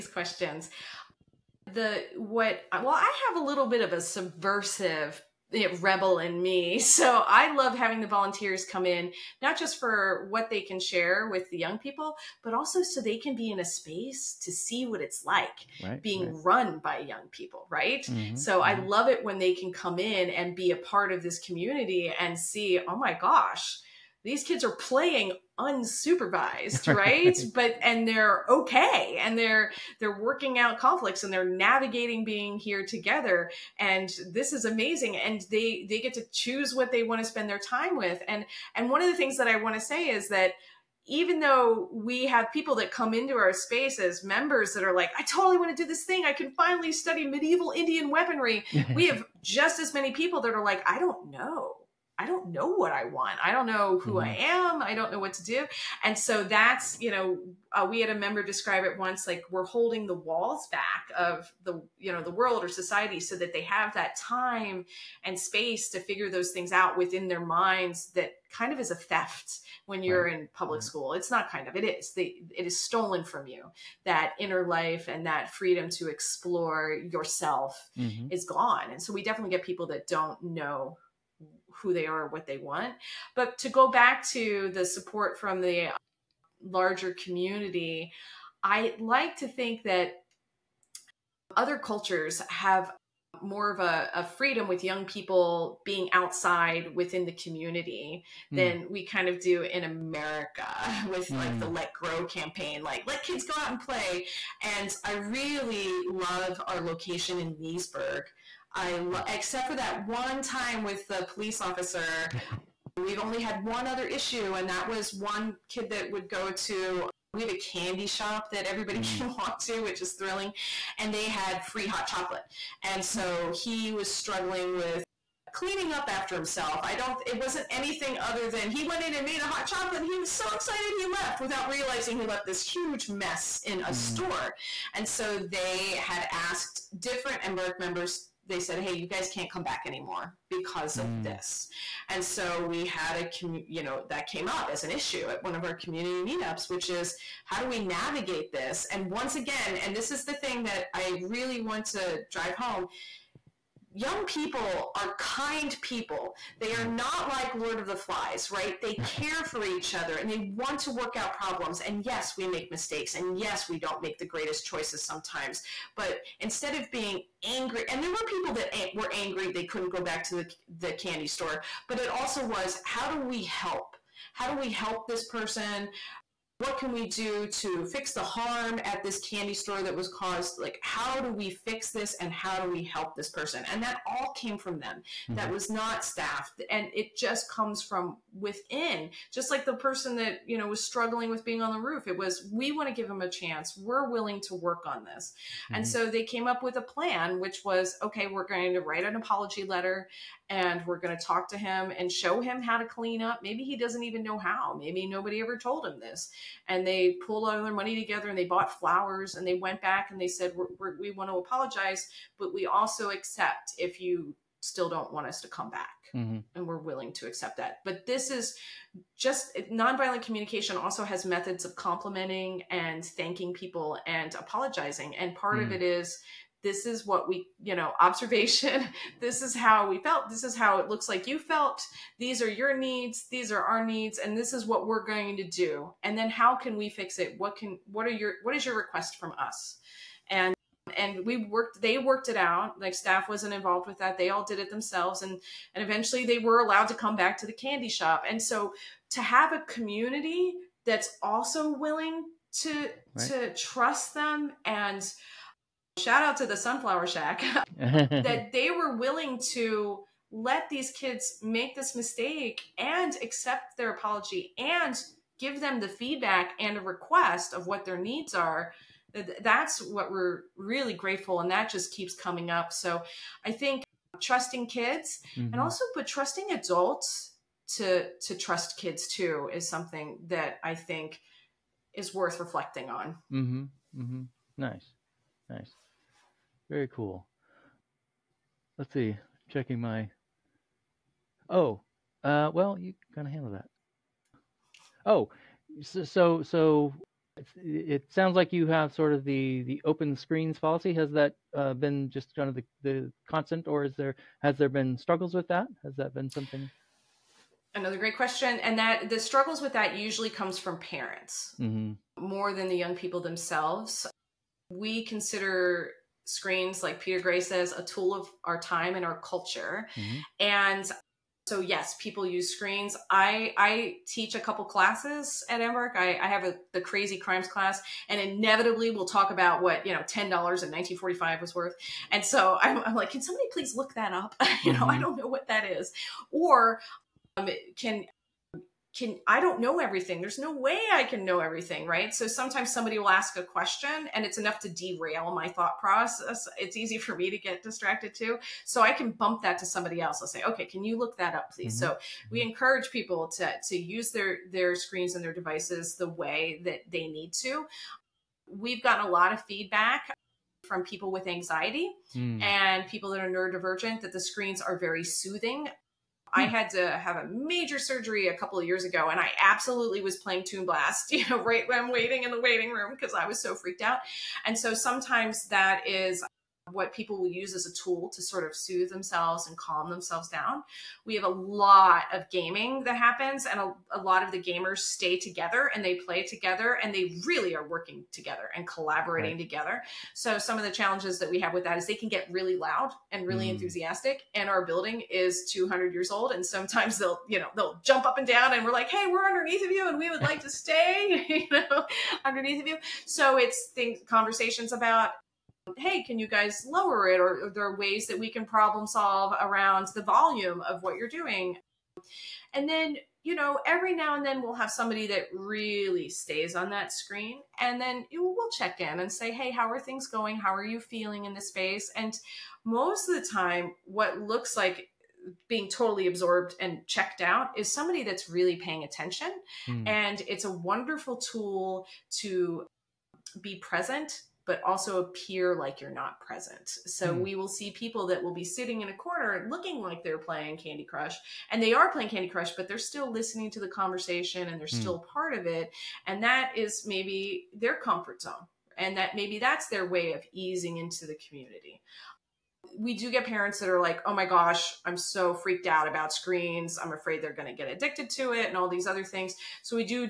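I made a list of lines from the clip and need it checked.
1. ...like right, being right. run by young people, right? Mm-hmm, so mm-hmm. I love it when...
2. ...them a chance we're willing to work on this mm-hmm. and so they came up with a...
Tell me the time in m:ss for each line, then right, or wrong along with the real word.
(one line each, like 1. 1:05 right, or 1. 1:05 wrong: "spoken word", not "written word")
1. 0:15 right
2. 3:13 right.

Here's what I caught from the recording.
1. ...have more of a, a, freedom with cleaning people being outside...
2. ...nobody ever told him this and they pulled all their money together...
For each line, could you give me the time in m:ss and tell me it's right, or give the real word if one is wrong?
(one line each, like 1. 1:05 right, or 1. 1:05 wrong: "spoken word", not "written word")
1. 1:32 wrong: "young", not "cleaning"
2. 3:25 right.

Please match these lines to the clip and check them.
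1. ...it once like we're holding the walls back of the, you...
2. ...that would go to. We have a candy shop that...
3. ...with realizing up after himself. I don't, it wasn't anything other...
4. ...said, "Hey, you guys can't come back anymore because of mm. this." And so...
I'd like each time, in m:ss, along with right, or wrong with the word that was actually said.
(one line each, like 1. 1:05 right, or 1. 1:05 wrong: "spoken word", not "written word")
1. 0:58 right
2. 1:55 right
3. 2:04 wrong: "cleaning", not "realizing"
4. 2:18 right.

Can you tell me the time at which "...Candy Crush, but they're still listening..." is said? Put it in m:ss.
7:22.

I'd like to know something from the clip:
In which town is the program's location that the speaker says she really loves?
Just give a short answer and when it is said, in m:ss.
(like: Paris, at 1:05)
Leesburg, at 1:47.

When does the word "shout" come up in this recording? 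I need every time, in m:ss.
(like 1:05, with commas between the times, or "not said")
4:15.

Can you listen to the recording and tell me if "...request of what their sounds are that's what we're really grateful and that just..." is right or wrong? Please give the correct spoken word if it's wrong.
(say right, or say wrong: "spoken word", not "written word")
wrong: "needs", not "sounds".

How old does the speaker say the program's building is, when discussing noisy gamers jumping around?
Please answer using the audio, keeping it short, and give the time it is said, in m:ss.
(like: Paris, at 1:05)
200 years, at 6:35.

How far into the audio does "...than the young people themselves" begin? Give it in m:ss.
5:12.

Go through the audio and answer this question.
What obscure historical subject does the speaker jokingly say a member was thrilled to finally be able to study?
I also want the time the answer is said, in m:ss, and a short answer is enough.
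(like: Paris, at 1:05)
Medieval Indian weaponry, at 0:47.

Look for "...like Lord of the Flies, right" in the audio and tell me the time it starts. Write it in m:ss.
2:37.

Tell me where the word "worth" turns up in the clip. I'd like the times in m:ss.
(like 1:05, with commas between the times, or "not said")
4:42, 5:31.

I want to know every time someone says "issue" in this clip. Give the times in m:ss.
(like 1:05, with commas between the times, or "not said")
1:54, 2:24.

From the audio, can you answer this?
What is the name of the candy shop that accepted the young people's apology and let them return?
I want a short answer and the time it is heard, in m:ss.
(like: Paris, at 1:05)
Sunflower Shack, at 4:16.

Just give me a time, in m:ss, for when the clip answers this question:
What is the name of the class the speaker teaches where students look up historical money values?
5:26.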